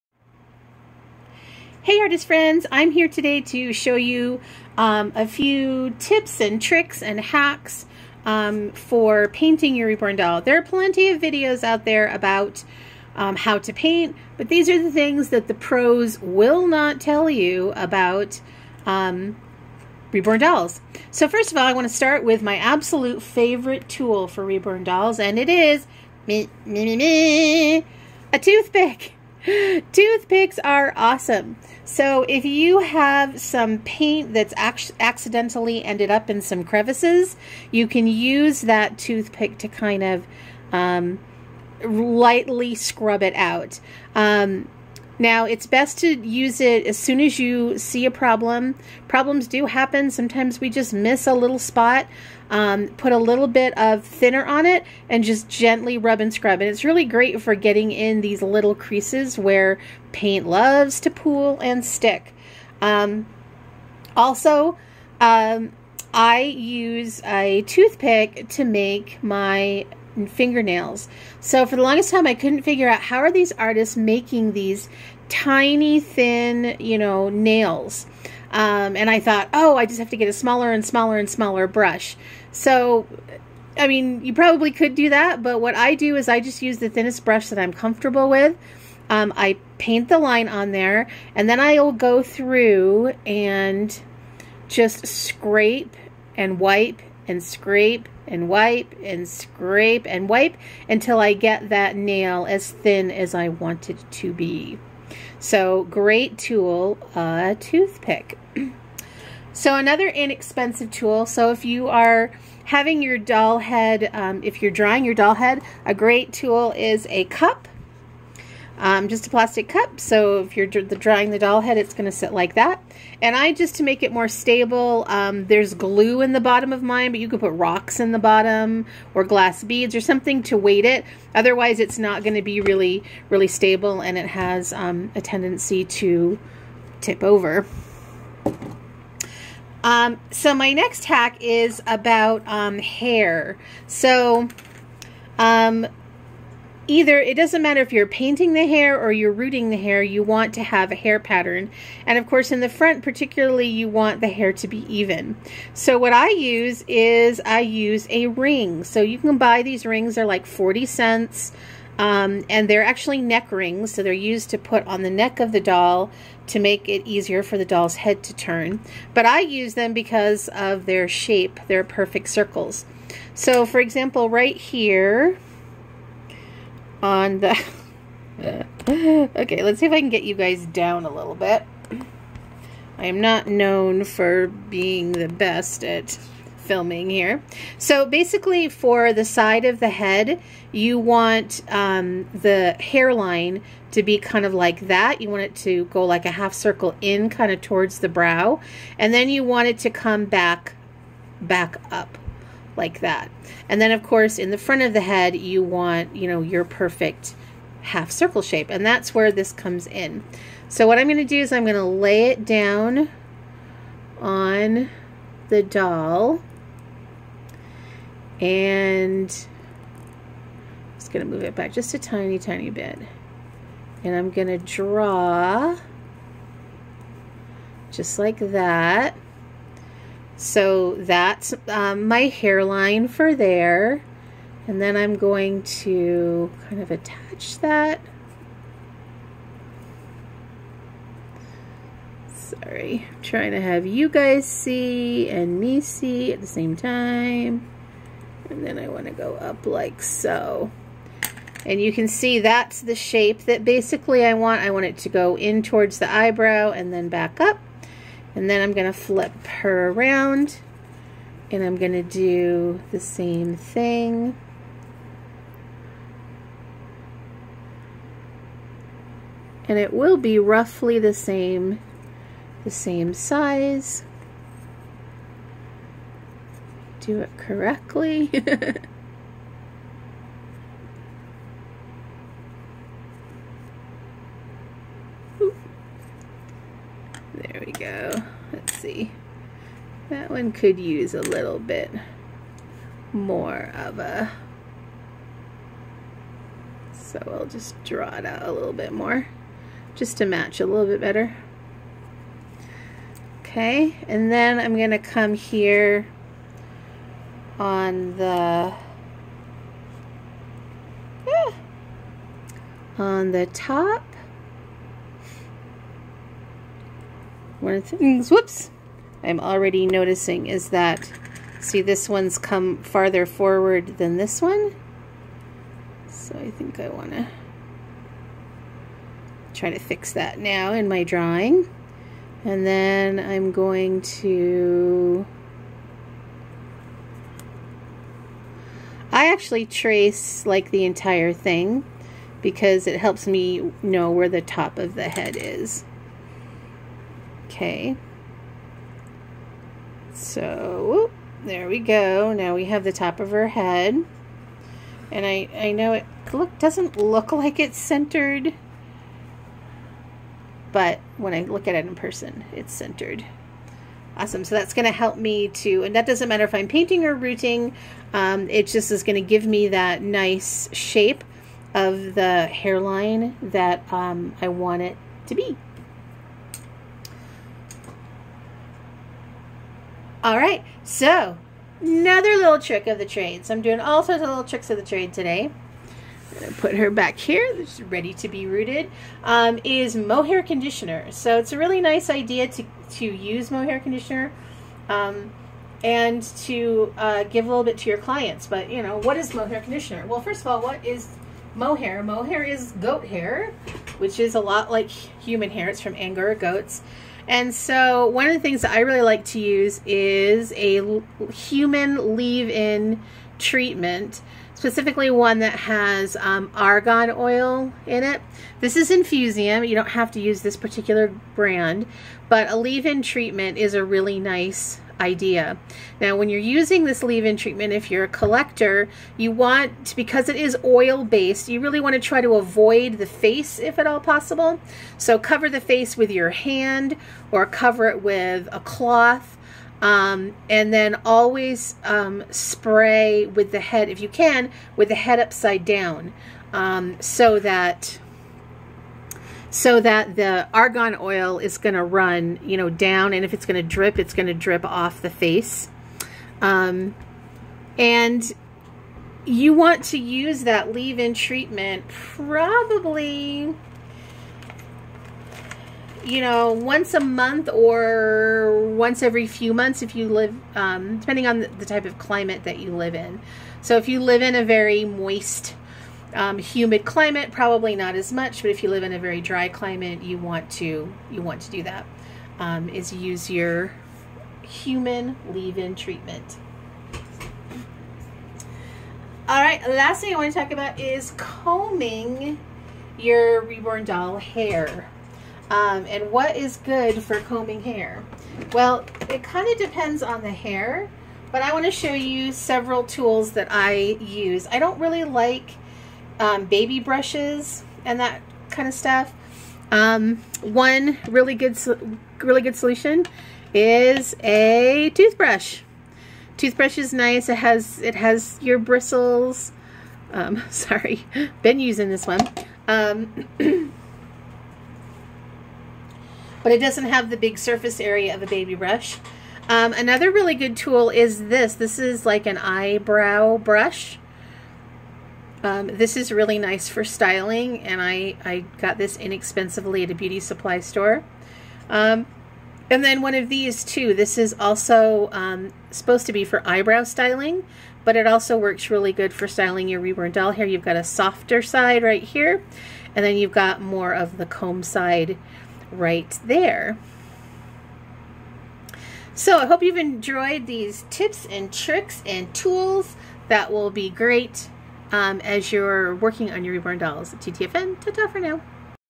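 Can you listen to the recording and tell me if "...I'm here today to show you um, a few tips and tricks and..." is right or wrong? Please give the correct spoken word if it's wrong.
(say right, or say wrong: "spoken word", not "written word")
right.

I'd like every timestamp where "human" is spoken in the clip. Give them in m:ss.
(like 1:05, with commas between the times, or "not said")
6:44, 6:51, 8:04.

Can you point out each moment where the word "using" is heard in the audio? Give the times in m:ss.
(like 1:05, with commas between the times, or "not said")
7:06, 8:41.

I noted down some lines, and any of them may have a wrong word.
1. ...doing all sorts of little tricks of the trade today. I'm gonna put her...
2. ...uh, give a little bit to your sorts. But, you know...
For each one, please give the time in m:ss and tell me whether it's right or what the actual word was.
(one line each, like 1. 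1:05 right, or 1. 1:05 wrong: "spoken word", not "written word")
1. 6:23 right
2. 6:36 wrong: "clients", not "sorts".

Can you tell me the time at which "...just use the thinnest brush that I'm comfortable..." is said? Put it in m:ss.
1:26.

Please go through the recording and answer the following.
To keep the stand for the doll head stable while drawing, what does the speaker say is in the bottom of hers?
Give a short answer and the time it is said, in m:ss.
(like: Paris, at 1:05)
Glue, at 2:05.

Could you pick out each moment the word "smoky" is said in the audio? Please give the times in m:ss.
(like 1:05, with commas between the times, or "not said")
not said.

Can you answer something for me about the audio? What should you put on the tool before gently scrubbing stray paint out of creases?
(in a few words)
Thinner.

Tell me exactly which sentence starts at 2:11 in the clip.
Otherwise, it's not going to be really, really stable and it has um, a tendency to tip over.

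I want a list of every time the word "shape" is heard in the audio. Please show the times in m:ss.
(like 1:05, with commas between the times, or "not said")
2:51, 3:28, 4:12, 6:10.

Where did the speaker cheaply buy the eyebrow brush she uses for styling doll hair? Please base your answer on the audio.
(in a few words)
Beauty supply store.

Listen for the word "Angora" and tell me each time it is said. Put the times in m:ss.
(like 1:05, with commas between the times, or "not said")
6:45.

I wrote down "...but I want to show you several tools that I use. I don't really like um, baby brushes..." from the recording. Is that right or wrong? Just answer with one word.
right.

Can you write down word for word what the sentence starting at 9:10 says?
You've got a softer side right here, and then you've got more of the comb side right there.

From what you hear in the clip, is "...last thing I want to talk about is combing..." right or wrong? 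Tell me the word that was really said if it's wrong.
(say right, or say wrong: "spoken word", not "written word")
right.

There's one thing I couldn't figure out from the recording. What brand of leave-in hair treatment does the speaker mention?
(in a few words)
Infusium.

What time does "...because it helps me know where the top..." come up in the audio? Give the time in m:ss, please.
5:42.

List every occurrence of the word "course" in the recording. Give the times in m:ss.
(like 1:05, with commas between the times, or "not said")
2:32, 3:24.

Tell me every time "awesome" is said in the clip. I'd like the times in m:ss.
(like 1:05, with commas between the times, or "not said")
0:30, 6:04.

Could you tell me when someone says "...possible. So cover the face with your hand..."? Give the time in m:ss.
7:13.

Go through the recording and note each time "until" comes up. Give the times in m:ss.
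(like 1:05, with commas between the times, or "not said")
1:40.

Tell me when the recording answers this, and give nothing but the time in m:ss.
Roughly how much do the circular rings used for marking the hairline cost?
2:40.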